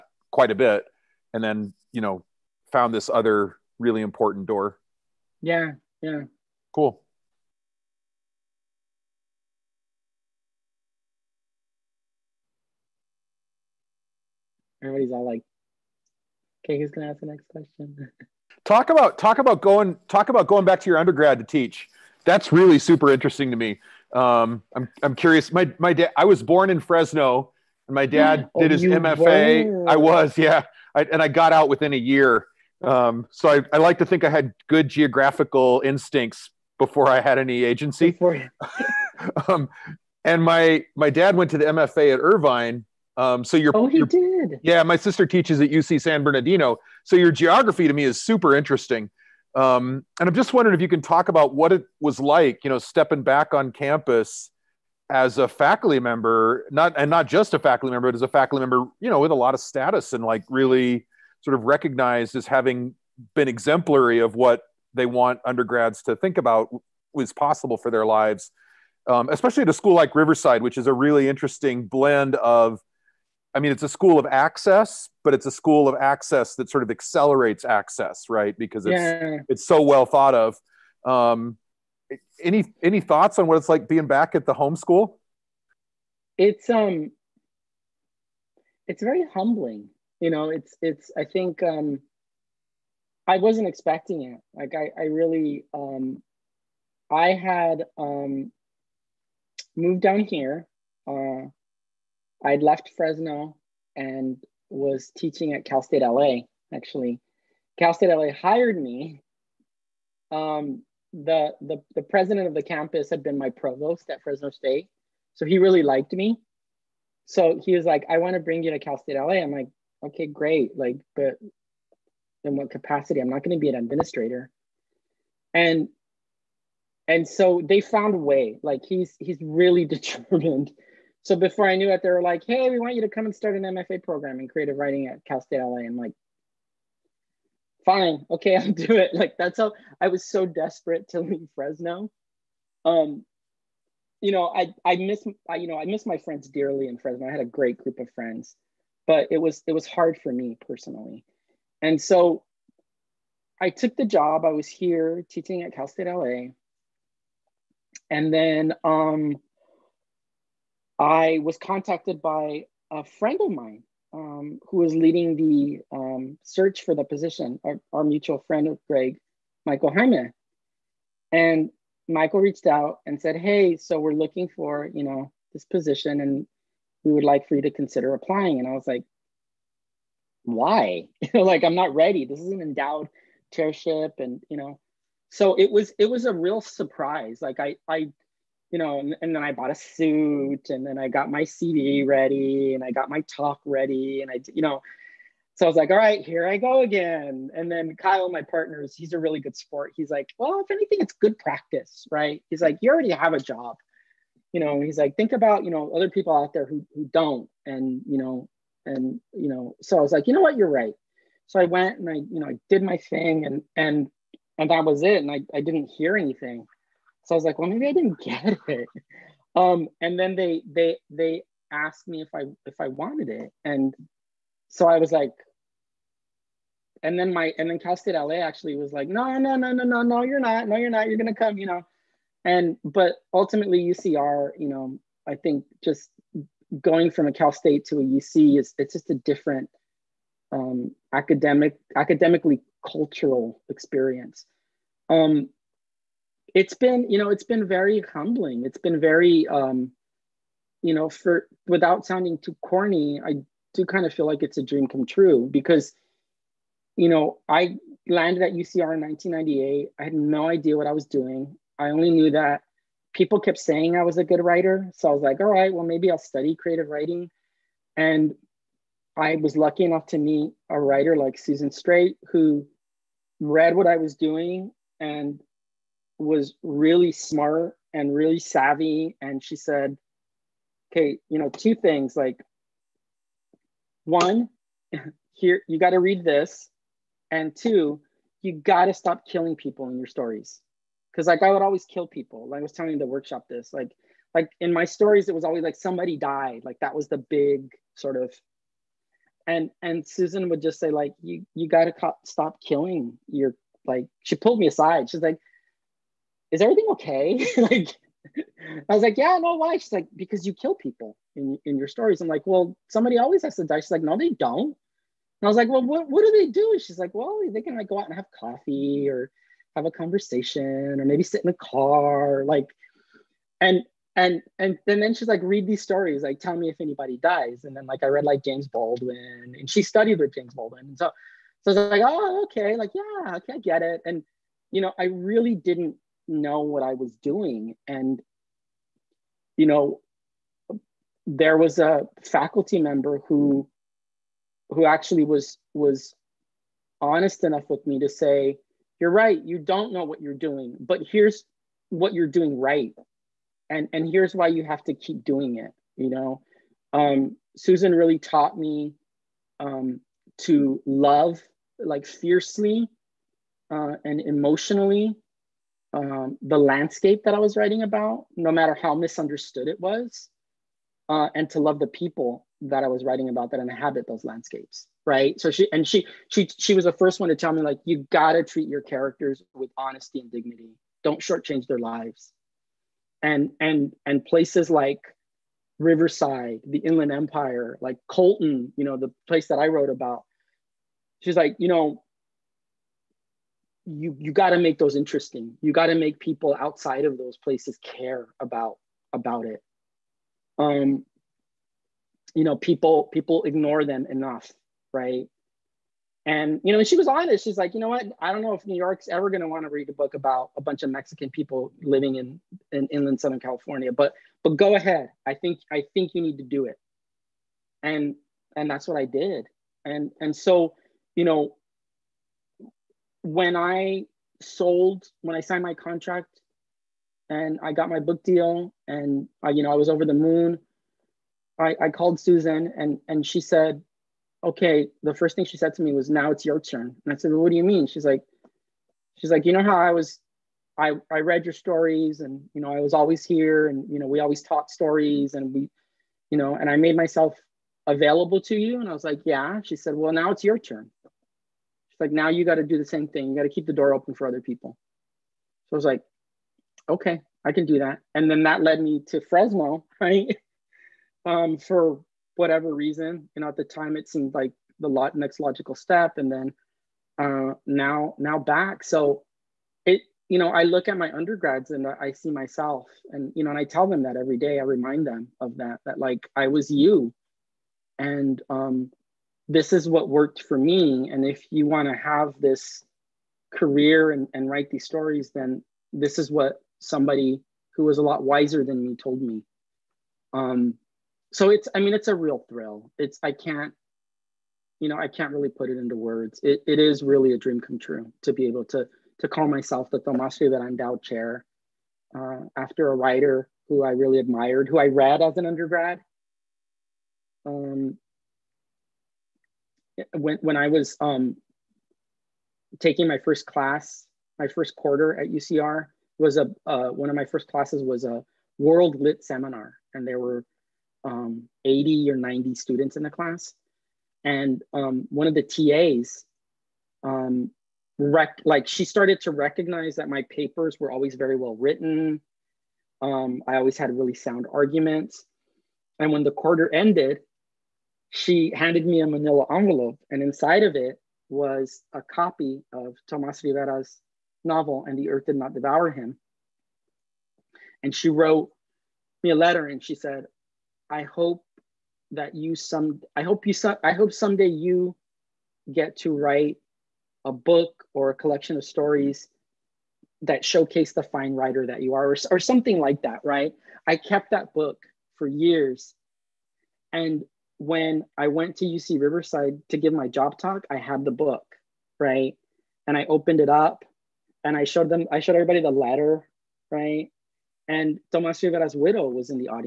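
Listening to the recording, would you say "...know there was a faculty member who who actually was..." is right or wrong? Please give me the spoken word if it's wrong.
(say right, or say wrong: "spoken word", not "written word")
right.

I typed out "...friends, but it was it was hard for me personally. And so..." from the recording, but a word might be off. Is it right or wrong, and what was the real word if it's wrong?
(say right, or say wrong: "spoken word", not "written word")
right.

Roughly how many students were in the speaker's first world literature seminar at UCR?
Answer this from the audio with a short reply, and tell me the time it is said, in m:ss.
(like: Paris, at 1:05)
80 or 90, at 8:41.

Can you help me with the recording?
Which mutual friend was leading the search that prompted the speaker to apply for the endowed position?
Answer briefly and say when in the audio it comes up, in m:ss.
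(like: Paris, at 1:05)
Michael Hyman, at 2:49.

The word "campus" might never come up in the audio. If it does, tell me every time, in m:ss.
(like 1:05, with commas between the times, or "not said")
0:53, 1:52.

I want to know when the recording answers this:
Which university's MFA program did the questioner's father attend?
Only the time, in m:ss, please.
0:42.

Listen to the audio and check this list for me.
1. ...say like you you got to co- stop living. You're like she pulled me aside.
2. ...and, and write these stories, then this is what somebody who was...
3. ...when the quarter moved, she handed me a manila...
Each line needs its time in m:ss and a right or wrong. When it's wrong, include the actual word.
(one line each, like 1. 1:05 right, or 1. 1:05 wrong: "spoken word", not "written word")
1. 5:00 wrong: "killing", not "living"
2. 8:04 right
3. 8:56 wrong: "ended", not "moved".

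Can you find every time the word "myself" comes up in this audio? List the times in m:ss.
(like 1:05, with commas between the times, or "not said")
7:26, 7:52, 8:19.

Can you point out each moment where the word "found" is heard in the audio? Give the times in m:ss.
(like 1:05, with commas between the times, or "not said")
0:02, 2:07.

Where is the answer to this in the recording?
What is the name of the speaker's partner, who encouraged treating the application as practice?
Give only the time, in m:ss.
3:17.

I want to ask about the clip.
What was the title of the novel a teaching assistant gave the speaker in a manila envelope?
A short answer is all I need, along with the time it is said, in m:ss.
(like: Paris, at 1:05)
And the Earth Did Not Devour Him, at 9:04.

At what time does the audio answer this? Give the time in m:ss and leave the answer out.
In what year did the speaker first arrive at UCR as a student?
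4:19.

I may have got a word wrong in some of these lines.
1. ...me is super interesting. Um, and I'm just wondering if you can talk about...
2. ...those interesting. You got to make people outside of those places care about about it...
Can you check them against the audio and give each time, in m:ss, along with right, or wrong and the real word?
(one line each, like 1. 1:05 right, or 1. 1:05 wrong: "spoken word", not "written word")
1. 0:47 right
2. 6:34 right.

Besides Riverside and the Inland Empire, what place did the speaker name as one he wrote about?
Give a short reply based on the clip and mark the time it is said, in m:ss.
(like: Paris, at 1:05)
Colton, at 6:28.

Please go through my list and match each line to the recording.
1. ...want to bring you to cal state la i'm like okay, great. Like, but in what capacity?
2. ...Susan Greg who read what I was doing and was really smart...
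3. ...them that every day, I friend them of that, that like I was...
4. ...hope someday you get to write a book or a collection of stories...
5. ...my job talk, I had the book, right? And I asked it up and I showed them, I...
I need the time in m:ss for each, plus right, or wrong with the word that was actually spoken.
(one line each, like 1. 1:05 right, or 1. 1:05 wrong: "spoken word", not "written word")
1. 1:58 right
2. 4:31 wrong: "Straight", not "Greg"
3. 7:53 wrong: "remind", not "friend"
4. 9:13 right
5. 9:29 wrong: "opened", not "asked".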